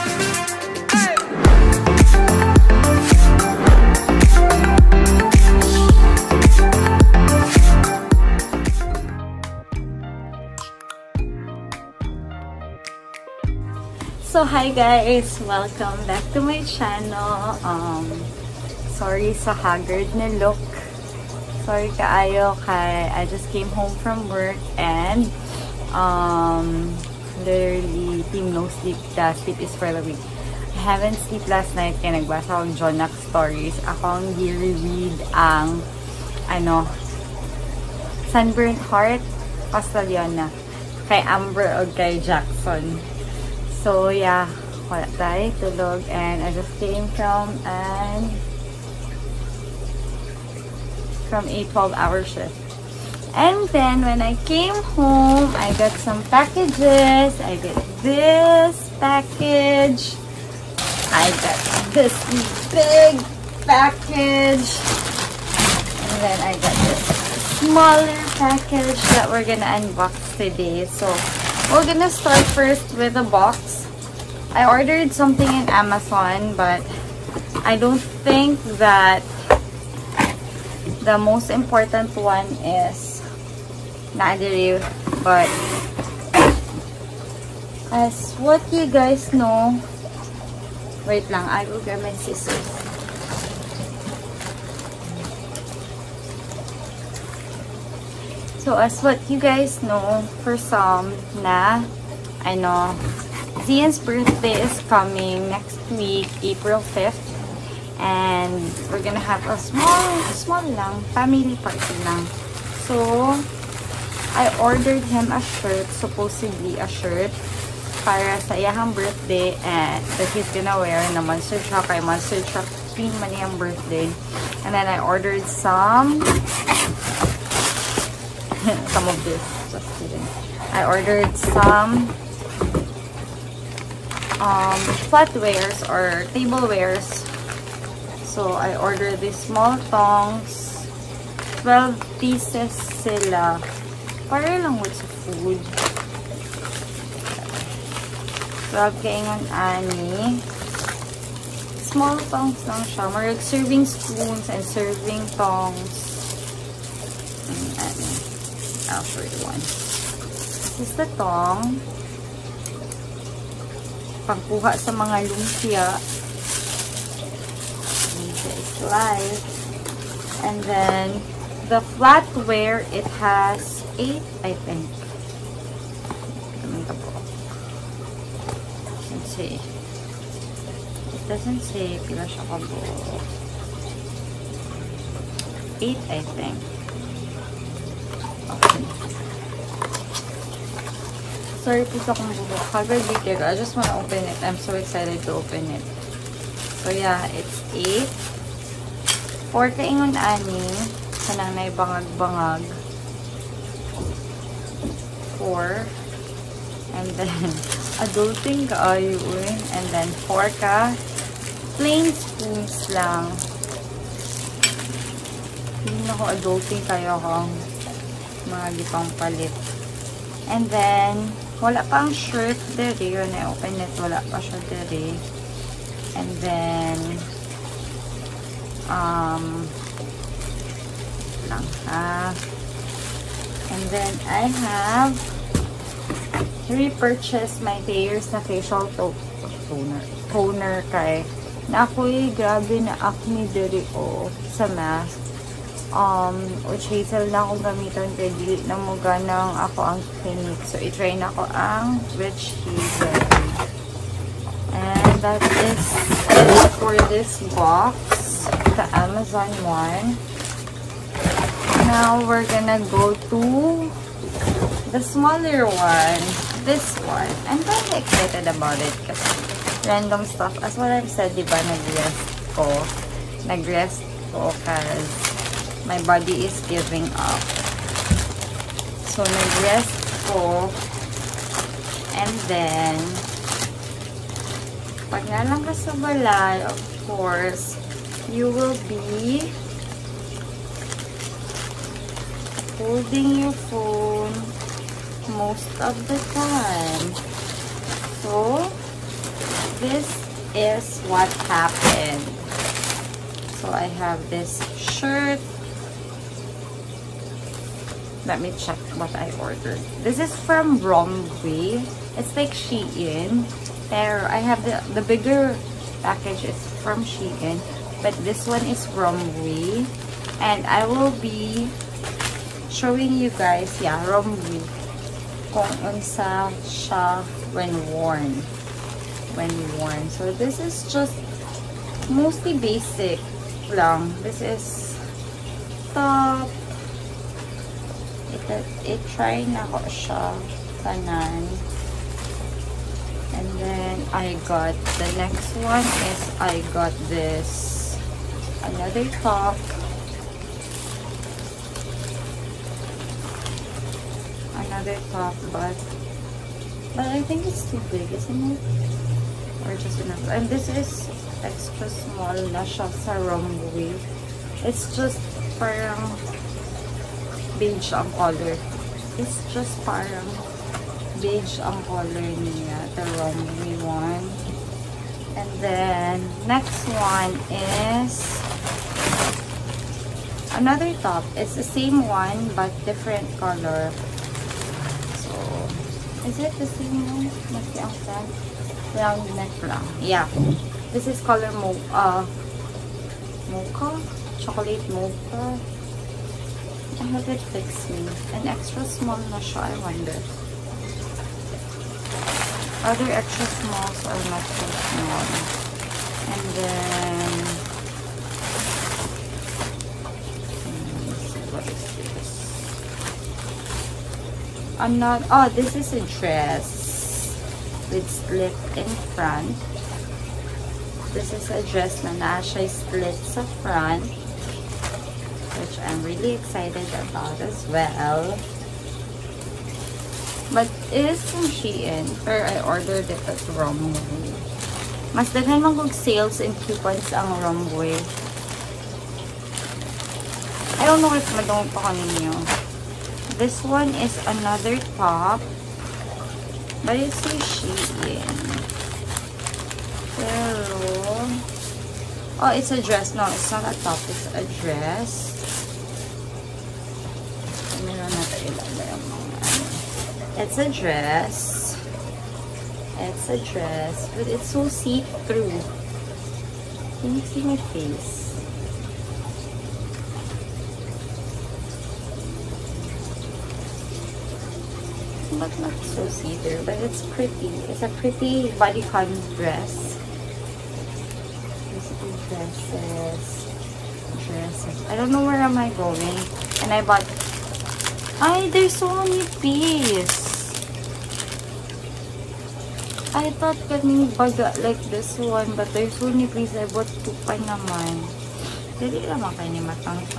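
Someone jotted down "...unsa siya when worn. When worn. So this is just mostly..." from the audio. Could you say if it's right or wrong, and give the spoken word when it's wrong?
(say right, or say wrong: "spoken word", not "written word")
right.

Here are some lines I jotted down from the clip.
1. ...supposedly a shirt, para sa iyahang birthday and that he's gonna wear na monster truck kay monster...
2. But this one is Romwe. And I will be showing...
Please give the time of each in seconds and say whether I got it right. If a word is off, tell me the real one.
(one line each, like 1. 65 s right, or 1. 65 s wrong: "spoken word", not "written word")
1. 115 s right
2. 318 s right.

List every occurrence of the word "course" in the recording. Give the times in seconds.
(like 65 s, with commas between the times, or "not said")
287 s.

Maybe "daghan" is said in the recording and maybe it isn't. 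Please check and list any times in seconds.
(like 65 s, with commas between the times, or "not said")
435 s.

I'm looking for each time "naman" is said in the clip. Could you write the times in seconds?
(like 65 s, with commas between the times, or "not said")
497 s.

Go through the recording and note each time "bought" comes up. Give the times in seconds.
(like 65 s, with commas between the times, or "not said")
486 s, 496 s.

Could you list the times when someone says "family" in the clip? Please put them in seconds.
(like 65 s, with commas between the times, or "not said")
111 s.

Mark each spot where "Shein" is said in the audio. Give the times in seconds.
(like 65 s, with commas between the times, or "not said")
312 s, 317 s, 431 s, 447 s.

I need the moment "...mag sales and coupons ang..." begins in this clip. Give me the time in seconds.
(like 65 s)
435 s.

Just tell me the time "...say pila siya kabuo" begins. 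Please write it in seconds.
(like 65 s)
181 s.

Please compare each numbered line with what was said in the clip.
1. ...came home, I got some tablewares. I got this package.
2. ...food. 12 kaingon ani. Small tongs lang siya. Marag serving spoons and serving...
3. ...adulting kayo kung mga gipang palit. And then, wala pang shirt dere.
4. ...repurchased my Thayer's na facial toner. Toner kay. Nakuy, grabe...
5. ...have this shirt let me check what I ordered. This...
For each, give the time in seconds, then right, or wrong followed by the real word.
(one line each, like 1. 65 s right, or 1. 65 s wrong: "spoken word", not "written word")
1. 54 s wrong: "packages", not "tablewares"
2. 145 s right
3. 216 s right
4. 236 s right
5. 303 s right.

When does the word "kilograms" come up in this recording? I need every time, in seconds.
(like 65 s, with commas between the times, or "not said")
not said.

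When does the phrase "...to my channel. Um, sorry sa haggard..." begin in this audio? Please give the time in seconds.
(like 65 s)
16 s.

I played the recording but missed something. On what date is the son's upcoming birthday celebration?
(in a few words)
April 5th.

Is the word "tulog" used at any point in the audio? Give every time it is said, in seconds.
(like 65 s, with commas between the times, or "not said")
45 s.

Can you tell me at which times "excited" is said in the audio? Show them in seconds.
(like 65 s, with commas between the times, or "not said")
194 s, 268 s, 426 s.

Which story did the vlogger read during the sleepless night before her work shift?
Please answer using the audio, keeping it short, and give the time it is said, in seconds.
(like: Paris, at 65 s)
Sunburnt Heart, at 38 s.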